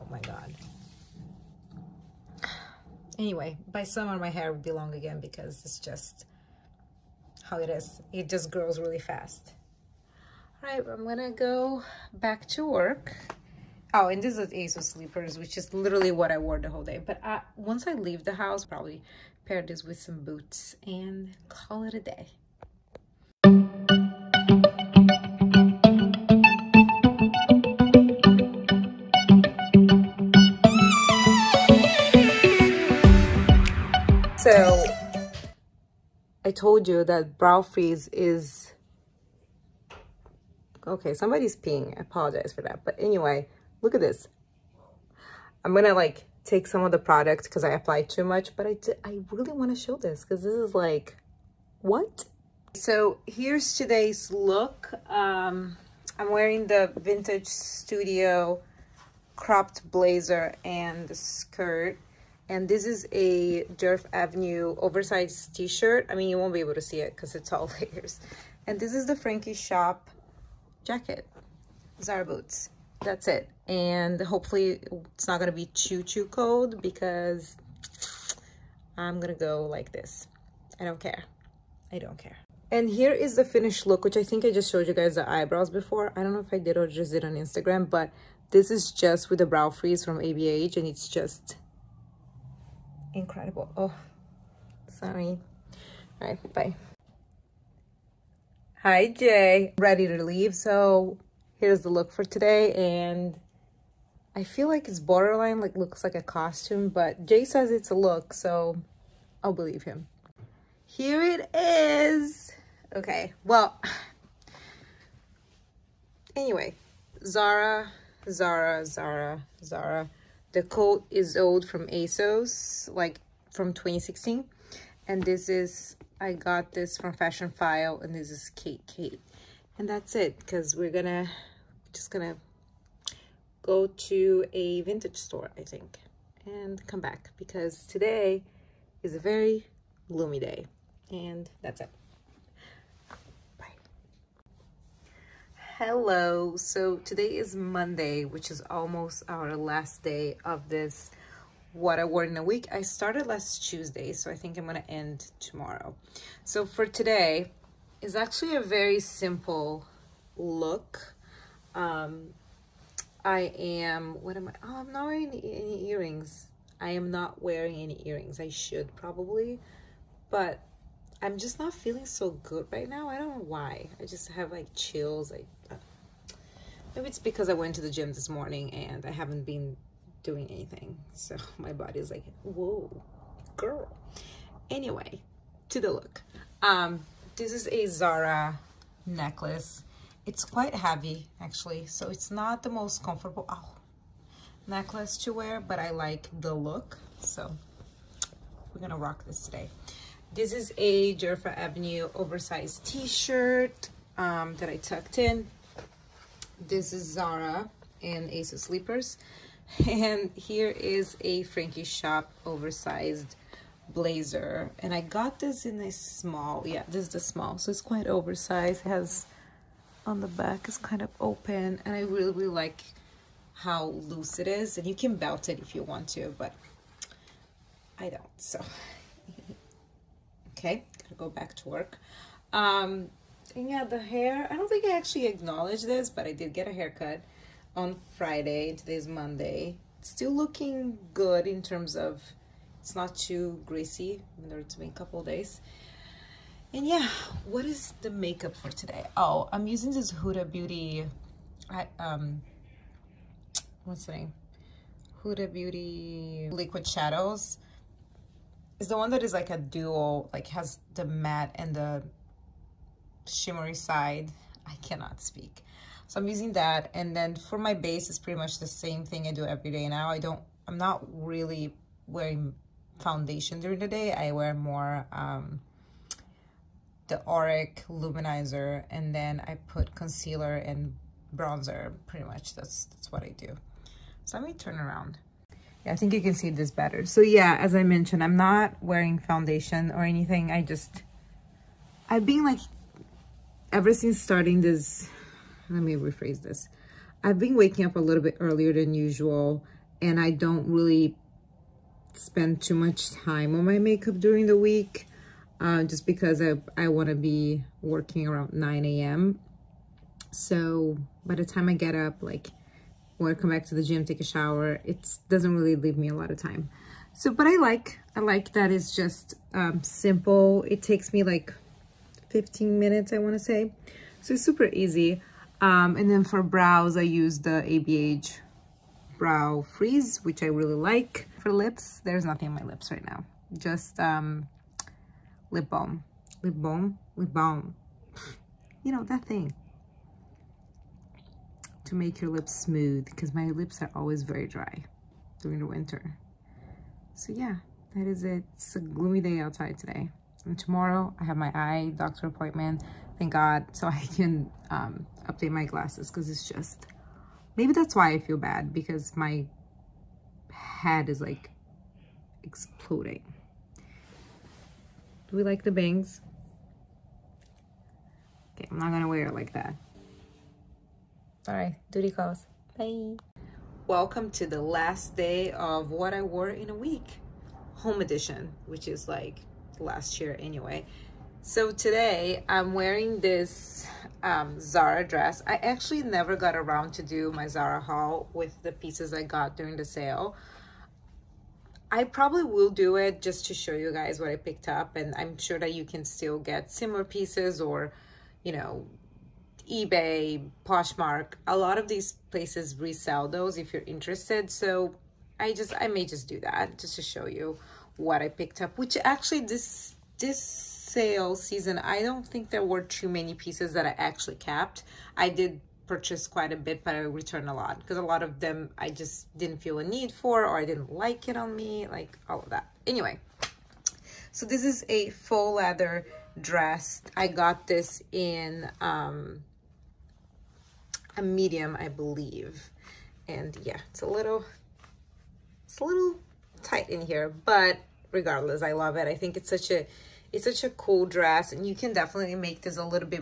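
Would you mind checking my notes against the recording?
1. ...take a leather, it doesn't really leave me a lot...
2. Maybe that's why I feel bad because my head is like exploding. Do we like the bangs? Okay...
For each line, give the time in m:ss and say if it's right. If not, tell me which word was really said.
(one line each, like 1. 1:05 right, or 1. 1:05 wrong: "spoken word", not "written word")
1. 5:14 wrong: "shower", not "leather"
2. 5:57 right.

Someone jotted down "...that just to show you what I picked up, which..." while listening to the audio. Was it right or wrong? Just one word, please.
right.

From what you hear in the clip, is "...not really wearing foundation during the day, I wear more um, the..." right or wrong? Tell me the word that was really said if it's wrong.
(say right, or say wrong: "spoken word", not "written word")
right.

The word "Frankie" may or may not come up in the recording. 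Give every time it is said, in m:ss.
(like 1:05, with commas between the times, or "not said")
1:09, 3:31.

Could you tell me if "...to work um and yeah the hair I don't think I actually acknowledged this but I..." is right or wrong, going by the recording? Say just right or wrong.
right.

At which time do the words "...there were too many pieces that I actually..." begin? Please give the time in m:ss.
6:52.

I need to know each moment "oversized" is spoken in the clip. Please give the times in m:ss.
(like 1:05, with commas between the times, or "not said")
1:04, 3:22, 3:32, 3:38.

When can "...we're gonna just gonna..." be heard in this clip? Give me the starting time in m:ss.
2:10.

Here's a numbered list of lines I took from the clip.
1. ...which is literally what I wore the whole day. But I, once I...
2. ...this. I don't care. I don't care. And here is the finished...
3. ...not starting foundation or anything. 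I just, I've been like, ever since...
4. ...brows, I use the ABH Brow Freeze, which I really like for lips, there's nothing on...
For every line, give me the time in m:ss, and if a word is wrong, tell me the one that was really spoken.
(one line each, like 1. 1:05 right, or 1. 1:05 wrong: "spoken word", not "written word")
1. 0:15 right
2. 1:19 right
3. 4:48 wrong: "wearing", not "starting"
4. 5:26 right.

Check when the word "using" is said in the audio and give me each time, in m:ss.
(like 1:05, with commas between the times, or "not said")
4:09, 4:26.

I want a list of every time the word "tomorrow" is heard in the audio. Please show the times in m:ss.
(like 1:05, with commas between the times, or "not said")
2:35, 5:50.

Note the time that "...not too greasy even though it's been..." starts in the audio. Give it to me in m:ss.
4:02.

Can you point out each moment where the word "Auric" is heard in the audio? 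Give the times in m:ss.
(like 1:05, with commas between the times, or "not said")
4:37.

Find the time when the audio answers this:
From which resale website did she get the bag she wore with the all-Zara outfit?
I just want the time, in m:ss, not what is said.
2:07.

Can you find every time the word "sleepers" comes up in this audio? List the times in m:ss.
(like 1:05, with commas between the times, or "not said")
0:14, 3:28.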